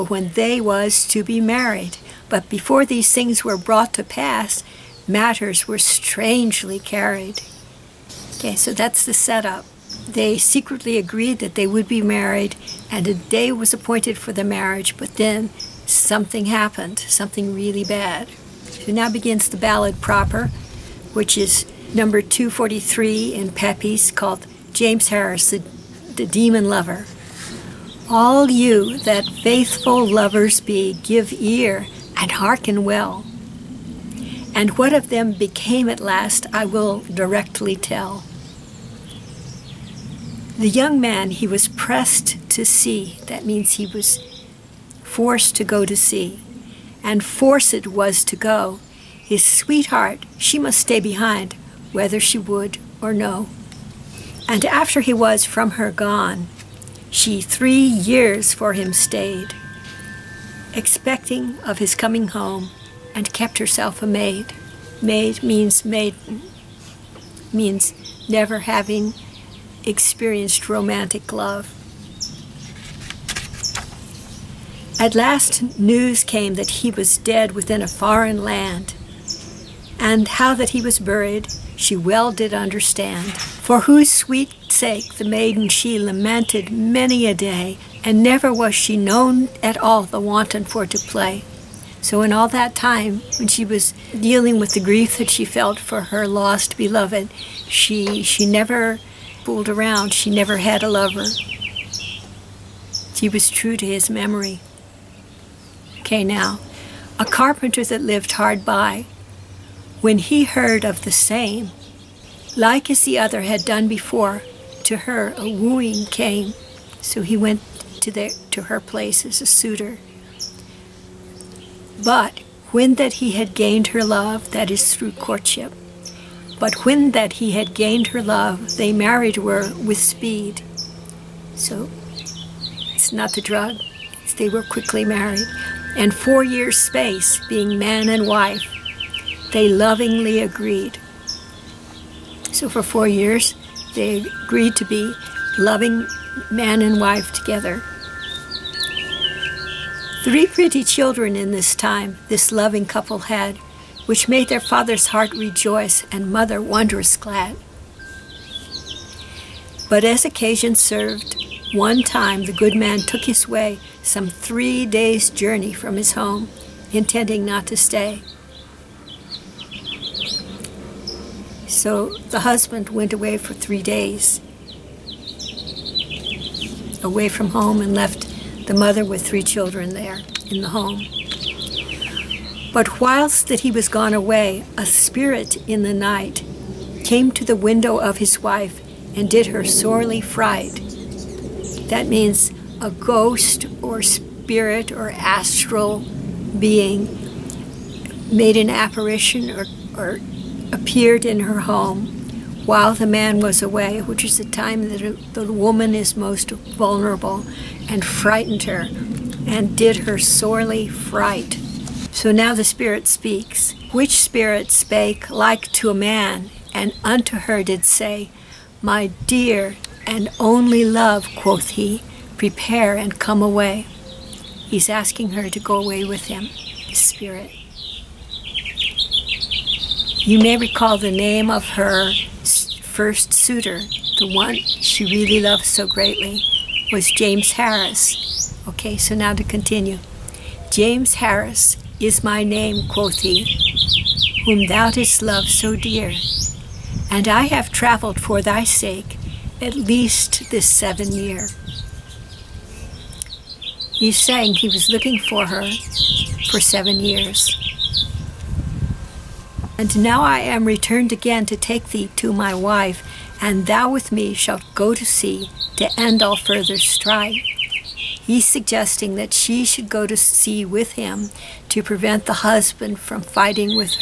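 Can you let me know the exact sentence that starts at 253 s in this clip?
He's saying he was looking for her for seven years.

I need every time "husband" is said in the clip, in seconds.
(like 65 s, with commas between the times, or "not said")
172 s, 272 s.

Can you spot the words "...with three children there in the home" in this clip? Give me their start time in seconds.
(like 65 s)
179 s.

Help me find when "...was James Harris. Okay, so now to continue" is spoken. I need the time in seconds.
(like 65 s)
236 s.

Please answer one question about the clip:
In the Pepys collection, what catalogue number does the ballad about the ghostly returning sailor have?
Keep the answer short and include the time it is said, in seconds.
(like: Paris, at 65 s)
243, at 22 s.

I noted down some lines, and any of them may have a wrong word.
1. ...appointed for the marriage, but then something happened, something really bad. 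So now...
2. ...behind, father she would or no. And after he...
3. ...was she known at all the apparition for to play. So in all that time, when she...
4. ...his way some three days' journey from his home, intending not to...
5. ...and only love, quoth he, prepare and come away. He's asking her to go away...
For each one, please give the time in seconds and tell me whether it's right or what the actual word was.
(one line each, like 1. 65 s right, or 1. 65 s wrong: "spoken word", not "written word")
1. 13 s right
2. 50 s wrong: "whether", not "father"
3. 88 s wrong: "wanton", not "apparition"
4. 163 s right
5. 220 s right.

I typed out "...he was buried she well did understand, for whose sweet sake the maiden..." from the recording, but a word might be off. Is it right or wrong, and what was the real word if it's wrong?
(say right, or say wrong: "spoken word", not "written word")
right.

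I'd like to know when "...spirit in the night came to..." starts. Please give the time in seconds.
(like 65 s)
184 s.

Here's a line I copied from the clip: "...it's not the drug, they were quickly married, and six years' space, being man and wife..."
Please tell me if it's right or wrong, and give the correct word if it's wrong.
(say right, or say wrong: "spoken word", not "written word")
wrong: "four", not "six".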